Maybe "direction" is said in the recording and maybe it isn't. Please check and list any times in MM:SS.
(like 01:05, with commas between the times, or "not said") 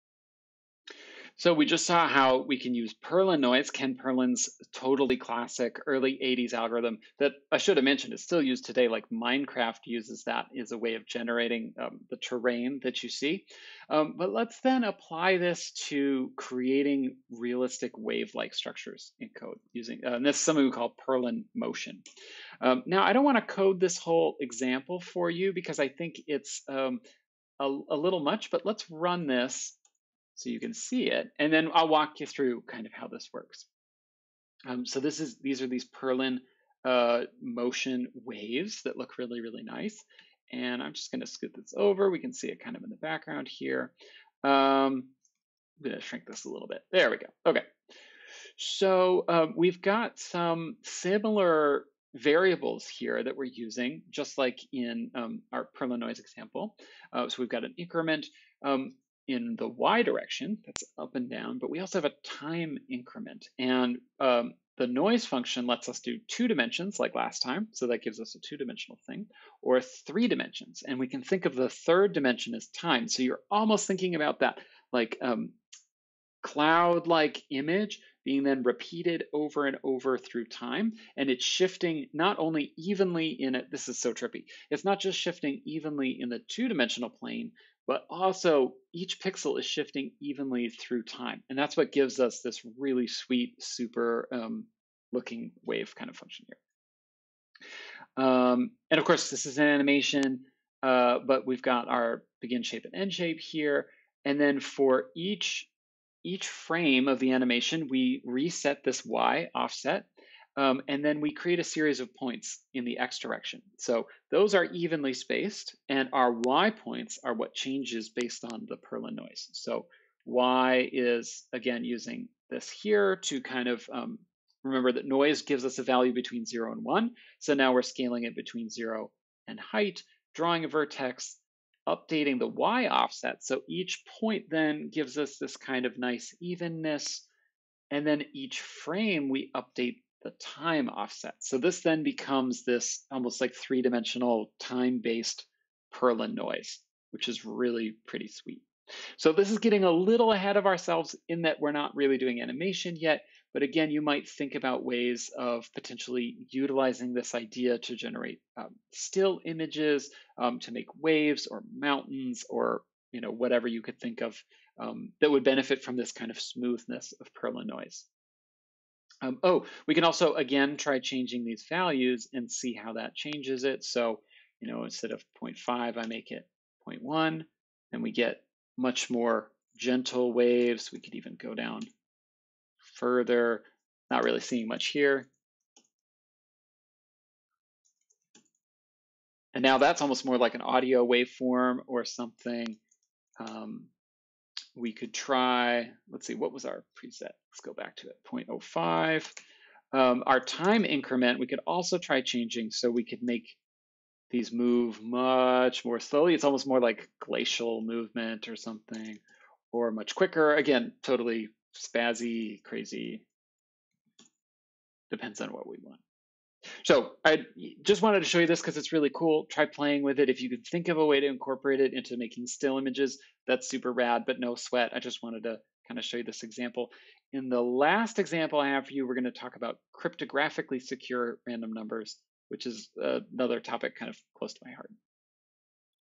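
01:00, 01:53.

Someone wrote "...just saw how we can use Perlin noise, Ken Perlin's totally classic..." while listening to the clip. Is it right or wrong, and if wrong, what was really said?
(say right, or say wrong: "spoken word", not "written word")
right.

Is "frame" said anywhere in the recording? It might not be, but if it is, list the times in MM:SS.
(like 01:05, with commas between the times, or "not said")
01:46, 02:18.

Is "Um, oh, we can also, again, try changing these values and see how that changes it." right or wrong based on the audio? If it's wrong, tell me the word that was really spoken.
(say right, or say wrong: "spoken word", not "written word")
right.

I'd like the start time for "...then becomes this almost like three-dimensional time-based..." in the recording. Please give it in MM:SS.
02:21.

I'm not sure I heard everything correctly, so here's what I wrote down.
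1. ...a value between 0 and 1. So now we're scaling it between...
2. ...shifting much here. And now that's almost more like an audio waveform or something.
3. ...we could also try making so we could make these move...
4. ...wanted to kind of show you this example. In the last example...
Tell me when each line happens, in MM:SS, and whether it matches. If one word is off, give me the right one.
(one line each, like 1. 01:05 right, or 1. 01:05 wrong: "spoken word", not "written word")
1. 02:05 right
2. 03:04 wrong: "seeing", not "shifting"
3. 03:21 wrong: "changing", not "making"
4. 03:45 right.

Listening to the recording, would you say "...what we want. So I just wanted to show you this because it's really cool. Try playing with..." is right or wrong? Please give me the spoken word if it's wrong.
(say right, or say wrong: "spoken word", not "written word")
right.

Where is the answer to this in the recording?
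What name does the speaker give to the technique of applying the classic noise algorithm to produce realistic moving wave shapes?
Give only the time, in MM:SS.
00:21.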